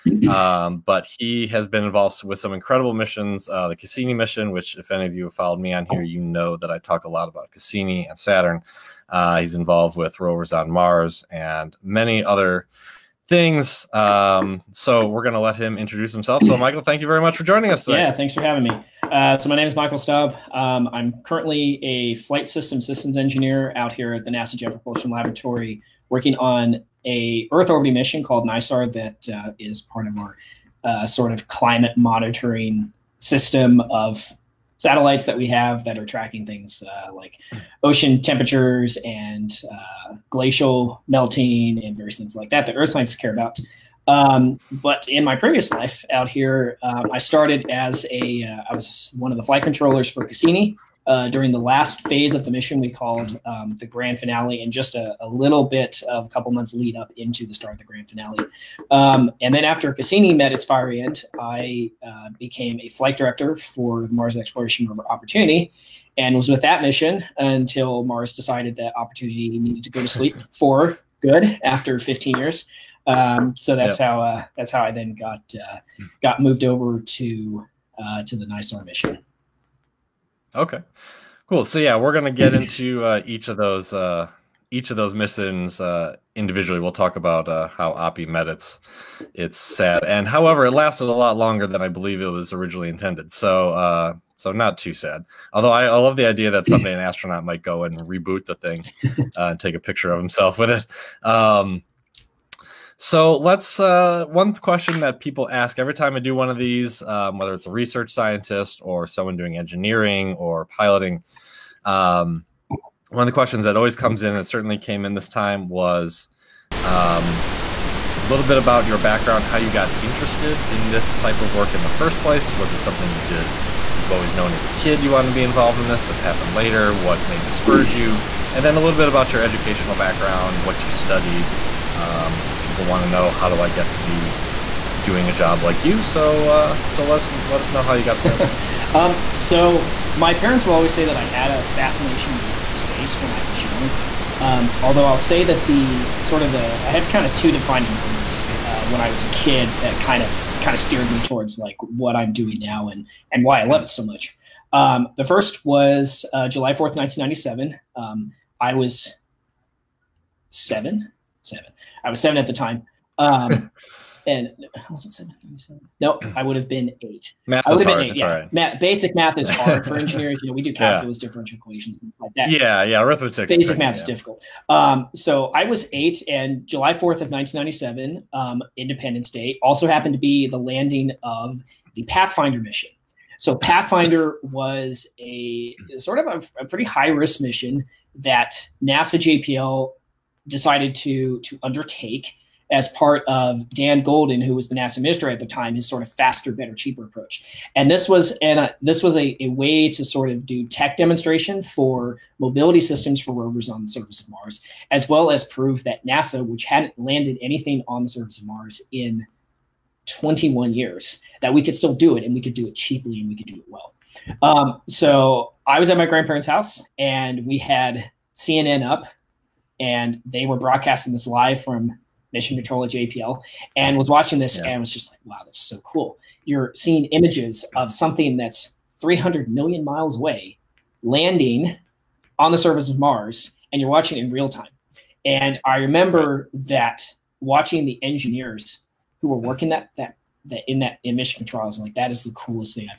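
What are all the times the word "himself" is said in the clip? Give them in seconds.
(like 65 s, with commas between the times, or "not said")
16 s, 100 s.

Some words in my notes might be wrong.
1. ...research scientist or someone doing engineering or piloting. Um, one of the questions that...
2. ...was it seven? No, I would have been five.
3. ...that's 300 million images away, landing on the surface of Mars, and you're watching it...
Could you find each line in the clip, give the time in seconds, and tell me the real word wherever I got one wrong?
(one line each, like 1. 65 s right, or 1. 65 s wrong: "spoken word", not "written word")
1. 107 s right
2. 164 s wrong: "eight", not "five"
3. 228 s wrong: "miles", not "images".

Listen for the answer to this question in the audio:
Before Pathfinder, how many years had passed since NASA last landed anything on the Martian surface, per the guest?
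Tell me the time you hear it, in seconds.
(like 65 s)
210 s.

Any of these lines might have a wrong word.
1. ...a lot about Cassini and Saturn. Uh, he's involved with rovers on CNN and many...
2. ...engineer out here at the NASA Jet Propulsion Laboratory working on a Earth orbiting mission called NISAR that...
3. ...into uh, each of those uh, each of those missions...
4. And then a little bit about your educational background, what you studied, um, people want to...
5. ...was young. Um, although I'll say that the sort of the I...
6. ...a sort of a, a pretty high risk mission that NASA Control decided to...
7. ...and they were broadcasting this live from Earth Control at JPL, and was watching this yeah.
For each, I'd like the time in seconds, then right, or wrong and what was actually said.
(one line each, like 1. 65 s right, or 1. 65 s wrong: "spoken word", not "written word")
1. 7 s wrong: "Mars", not "CNN"
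2. 23 s right
3. 82 s right
4. 128 s right
5. 143 s right
6. 185 s wrong: "JPL", not "Control"
7. 219 s wrong: "Mission", not "Earth".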